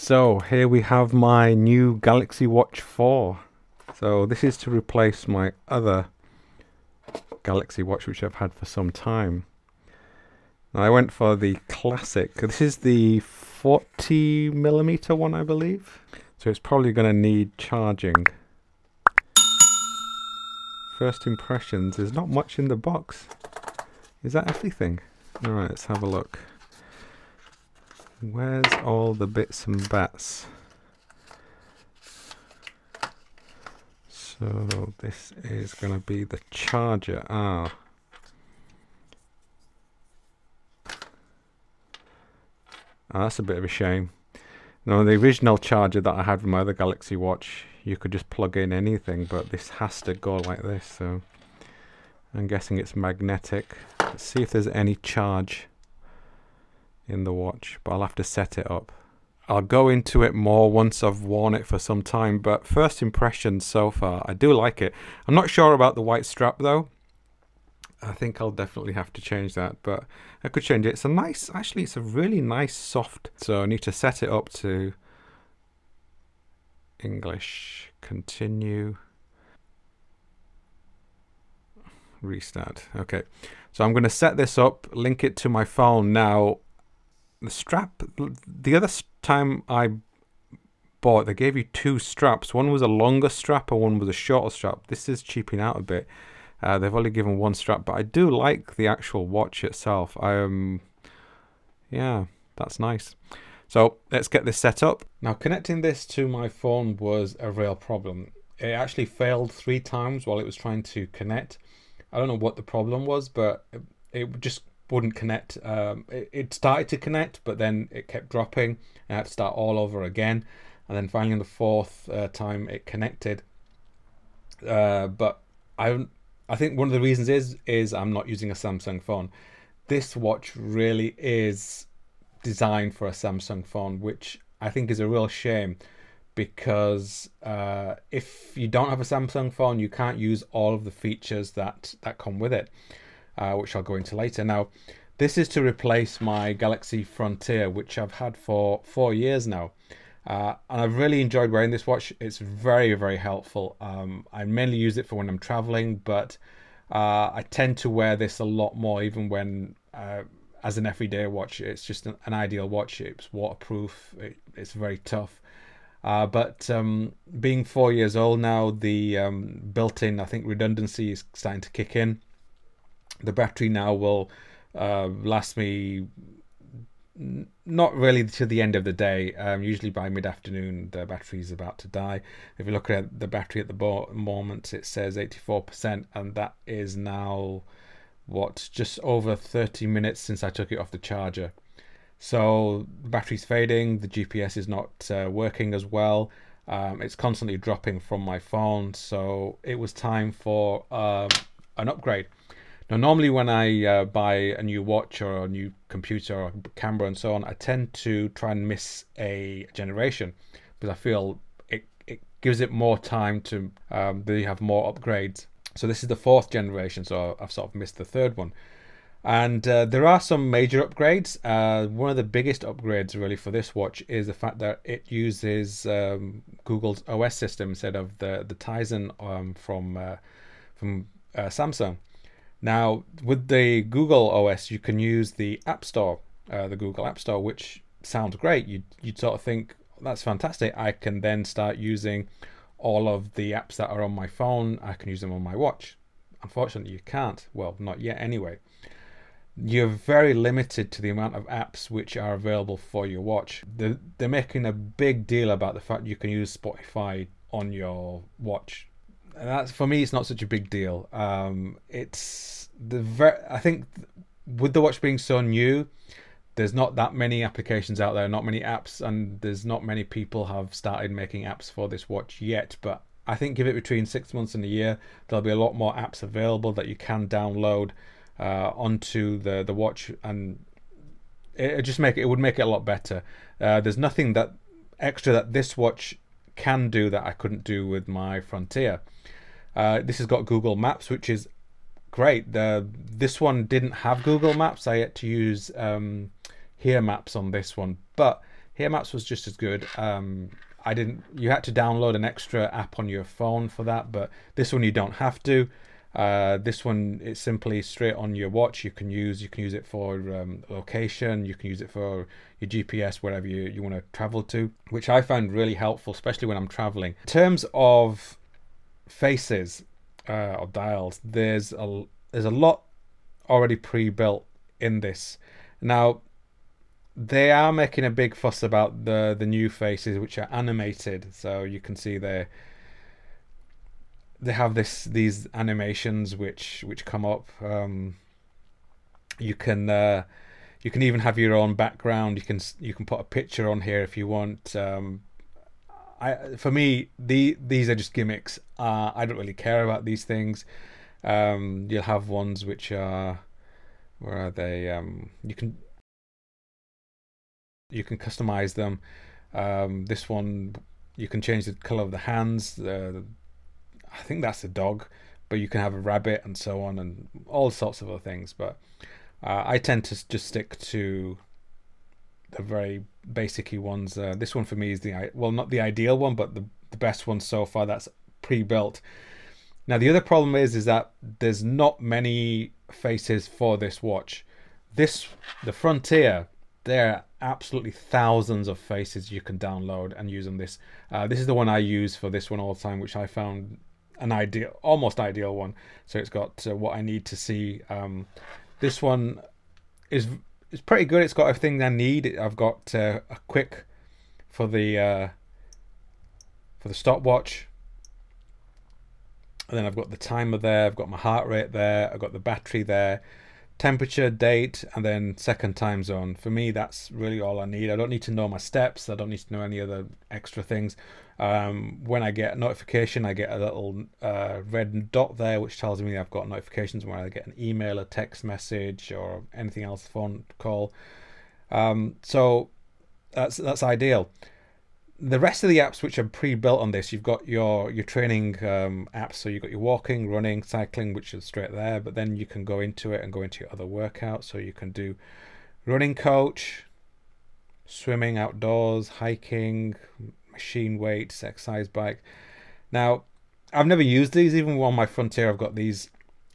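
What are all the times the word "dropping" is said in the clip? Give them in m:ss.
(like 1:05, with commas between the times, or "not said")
1:58, 3:17.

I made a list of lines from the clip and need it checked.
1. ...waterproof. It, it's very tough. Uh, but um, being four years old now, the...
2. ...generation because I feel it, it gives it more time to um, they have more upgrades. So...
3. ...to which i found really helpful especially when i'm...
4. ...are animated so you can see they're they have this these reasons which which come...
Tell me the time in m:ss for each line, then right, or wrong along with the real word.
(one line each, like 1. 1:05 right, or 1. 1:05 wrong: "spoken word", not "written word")
1. 2:43 right
2. 3:29 right
3. 5:14 right
4. 5:30 wrong: "animations", not "reasons".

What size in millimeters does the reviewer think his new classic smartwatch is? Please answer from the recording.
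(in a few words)
40 millimeter.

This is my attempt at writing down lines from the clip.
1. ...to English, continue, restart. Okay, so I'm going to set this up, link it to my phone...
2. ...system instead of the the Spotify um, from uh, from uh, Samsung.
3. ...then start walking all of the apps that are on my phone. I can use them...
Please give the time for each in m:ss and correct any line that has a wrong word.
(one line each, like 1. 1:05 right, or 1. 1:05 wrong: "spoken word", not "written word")
1. 1:14 right
2. 3:47 wrong: "Tizen", not "Spotify"
3. 4:01 wrong: "using", not "walking".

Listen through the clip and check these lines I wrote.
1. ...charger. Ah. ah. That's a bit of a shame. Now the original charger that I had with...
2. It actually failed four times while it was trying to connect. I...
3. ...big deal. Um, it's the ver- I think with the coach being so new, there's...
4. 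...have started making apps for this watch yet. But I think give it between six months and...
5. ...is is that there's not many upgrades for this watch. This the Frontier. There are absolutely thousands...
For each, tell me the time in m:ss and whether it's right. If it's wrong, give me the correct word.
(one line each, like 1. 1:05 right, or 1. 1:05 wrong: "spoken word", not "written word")
1. 0:36 right
2. 1:48 wrong: "three", not "four"
3. 4:20 wrong: "watch", not "coach"
4. 4:30 right
5. 6:20 wrong: "faces", not "upgrades".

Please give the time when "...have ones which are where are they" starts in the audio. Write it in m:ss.
5:52.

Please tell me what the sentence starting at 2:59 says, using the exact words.
Um, usually by mid afternoon, the battery is about to die.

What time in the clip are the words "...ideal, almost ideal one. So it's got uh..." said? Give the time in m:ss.
6:34.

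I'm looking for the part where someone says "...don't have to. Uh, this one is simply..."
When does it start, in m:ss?
5:04.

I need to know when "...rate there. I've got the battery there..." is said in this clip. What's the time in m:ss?
6:51.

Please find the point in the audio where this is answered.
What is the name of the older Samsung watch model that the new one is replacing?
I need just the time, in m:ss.
2:26.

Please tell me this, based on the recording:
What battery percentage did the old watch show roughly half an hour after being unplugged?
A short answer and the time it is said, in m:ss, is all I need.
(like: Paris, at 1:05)
84%, at 3:05.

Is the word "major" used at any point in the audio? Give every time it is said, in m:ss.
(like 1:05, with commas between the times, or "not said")
3:40.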